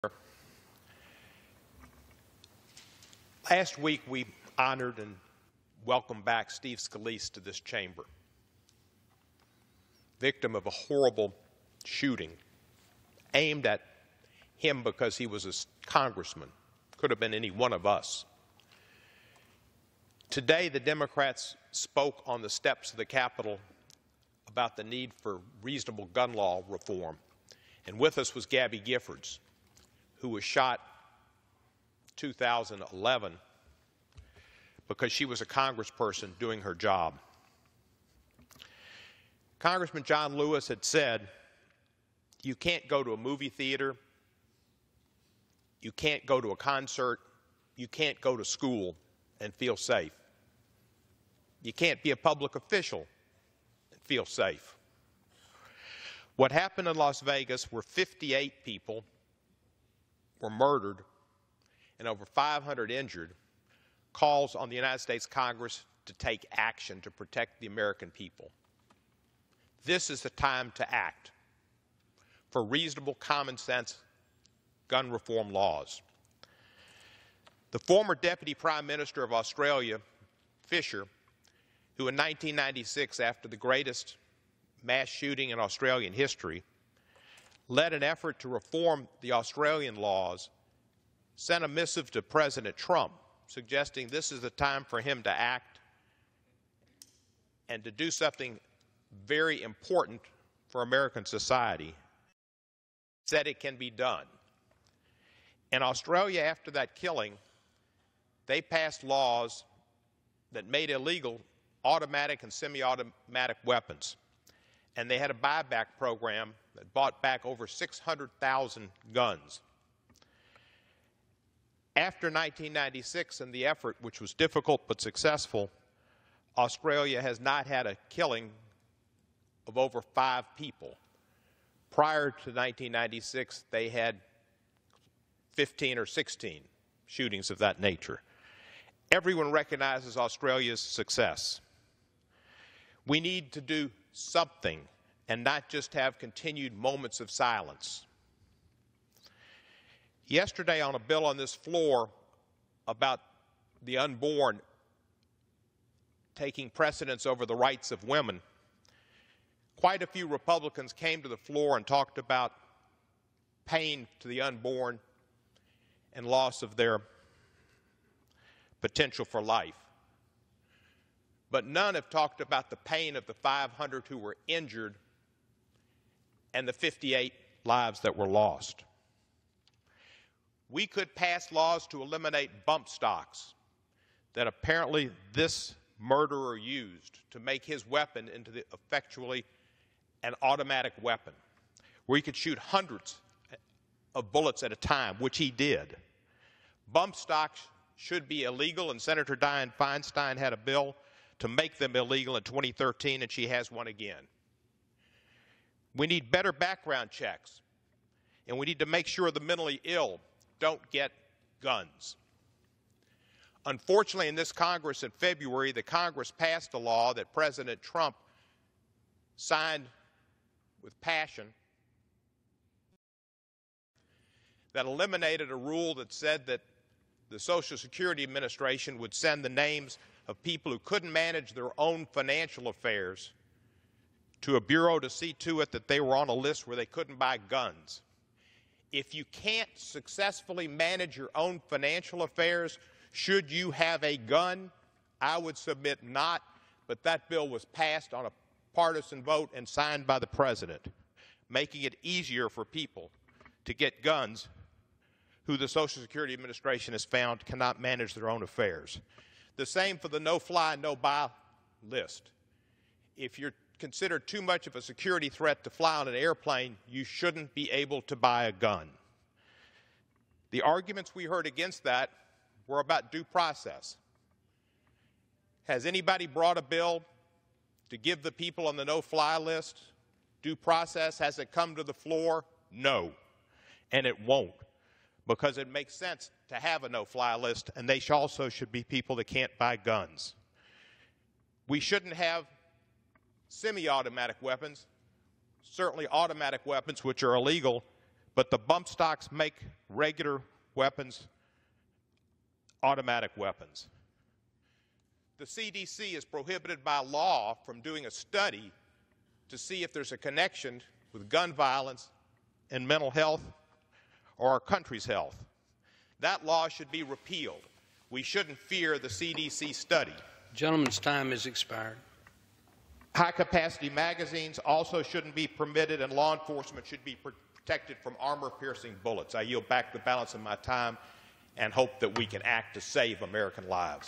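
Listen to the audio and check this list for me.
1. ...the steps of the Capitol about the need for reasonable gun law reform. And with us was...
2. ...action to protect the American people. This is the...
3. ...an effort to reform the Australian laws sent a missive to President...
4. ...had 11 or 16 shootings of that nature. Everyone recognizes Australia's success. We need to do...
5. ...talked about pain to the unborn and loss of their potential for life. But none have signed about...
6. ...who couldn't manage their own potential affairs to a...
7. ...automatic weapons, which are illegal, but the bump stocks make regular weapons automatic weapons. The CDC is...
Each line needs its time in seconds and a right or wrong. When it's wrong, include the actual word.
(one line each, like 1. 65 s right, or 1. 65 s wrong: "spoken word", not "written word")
1. 22 s right
2. 66 s right
3. 87 s right
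4. 133 s wrong: "15", not "11"
5. 161 s wrong: "talked", not "signed"
6. 230 s wrong: "financial", not "potential"
7. 296 s right.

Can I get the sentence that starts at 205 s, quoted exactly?
We need better background checks, and we need to make sure the mentally ill don't get guns.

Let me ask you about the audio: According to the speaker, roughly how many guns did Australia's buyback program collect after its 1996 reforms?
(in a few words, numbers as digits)
600,000.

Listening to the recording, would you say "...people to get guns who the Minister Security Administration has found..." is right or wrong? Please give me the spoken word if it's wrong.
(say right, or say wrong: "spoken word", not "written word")
wrong: "Social", not "Minister".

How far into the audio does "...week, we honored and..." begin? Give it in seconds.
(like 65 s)
3 s.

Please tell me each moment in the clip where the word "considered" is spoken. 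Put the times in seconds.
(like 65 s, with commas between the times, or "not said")
263 s.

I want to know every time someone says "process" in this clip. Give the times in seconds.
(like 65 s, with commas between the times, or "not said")
273 s, 280 s.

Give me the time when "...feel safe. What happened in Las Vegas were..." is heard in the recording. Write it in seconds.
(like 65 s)
54 s.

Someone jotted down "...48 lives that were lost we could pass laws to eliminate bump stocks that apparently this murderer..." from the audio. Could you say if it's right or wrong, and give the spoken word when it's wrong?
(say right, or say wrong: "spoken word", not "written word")
wrong: "58", not "48".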